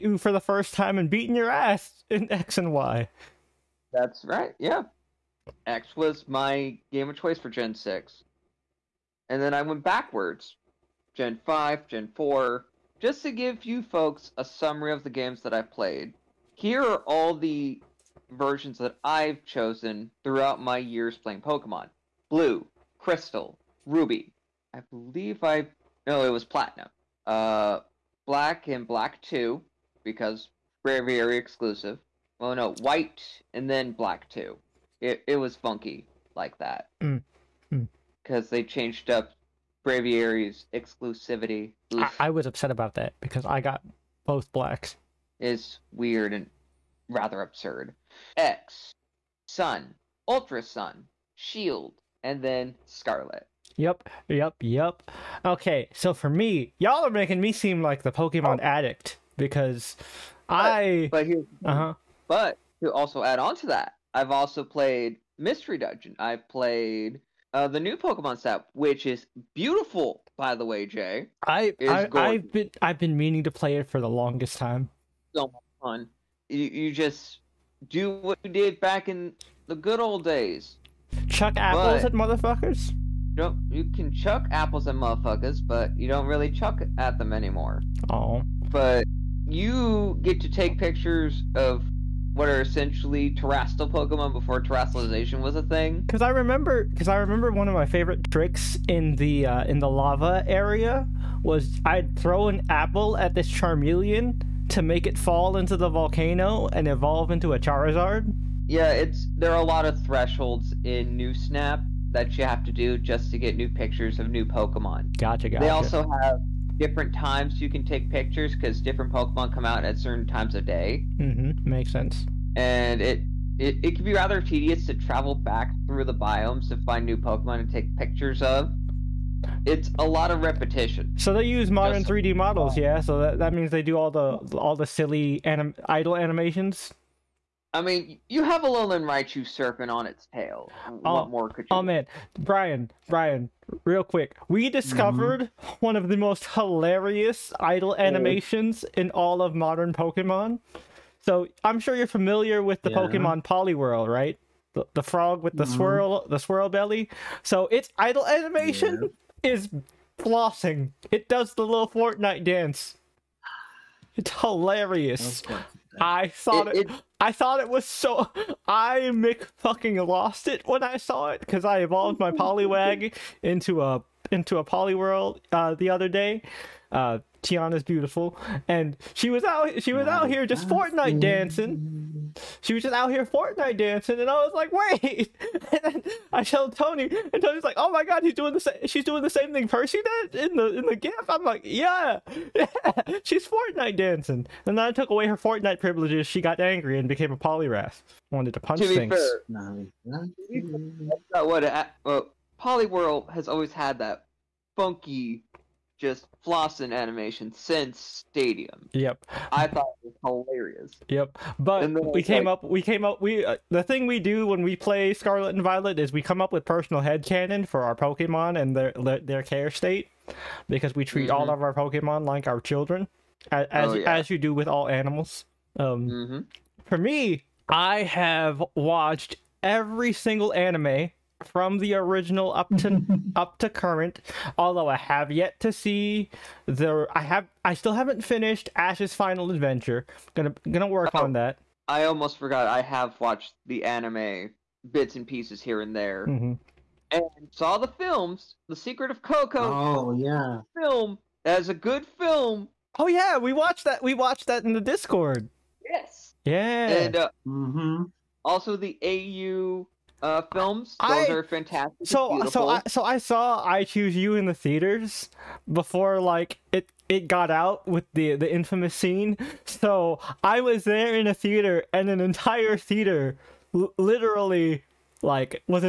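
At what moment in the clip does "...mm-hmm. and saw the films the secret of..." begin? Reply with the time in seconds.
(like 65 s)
246 s.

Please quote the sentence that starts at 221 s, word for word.
all of our Pokemon like our children, as as, oh, yeah.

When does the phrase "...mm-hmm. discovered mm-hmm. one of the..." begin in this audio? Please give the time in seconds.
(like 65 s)
144 s.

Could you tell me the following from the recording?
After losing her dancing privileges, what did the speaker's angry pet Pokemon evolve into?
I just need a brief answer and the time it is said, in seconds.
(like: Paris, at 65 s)
Poliwrath, at 197 s.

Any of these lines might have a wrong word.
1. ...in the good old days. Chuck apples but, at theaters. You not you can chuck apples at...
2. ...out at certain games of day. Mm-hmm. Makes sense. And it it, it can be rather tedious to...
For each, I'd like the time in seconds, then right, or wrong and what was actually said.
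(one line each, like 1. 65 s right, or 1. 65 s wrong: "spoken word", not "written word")
1. 79 s wrong: "motherfuckers", not "theaters"
2. 119 s wrong: "times", not "games".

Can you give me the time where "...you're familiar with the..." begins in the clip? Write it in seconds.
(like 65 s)
151 s.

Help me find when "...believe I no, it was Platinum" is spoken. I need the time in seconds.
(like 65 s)
24 s.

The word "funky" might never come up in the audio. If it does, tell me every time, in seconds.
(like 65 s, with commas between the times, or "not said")
35 s, 204 s.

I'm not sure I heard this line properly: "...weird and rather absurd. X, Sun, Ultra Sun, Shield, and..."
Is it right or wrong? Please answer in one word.
right.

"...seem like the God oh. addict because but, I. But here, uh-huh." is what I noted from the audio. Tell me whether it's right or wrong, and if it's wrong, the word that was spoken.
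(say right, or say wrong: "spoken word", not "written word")
wrong: "Pokemon", not "God".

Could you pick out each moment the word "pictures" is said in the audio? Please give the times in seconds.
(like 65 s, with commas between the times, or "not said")
90 s, 113 s, 118 s, 127 s.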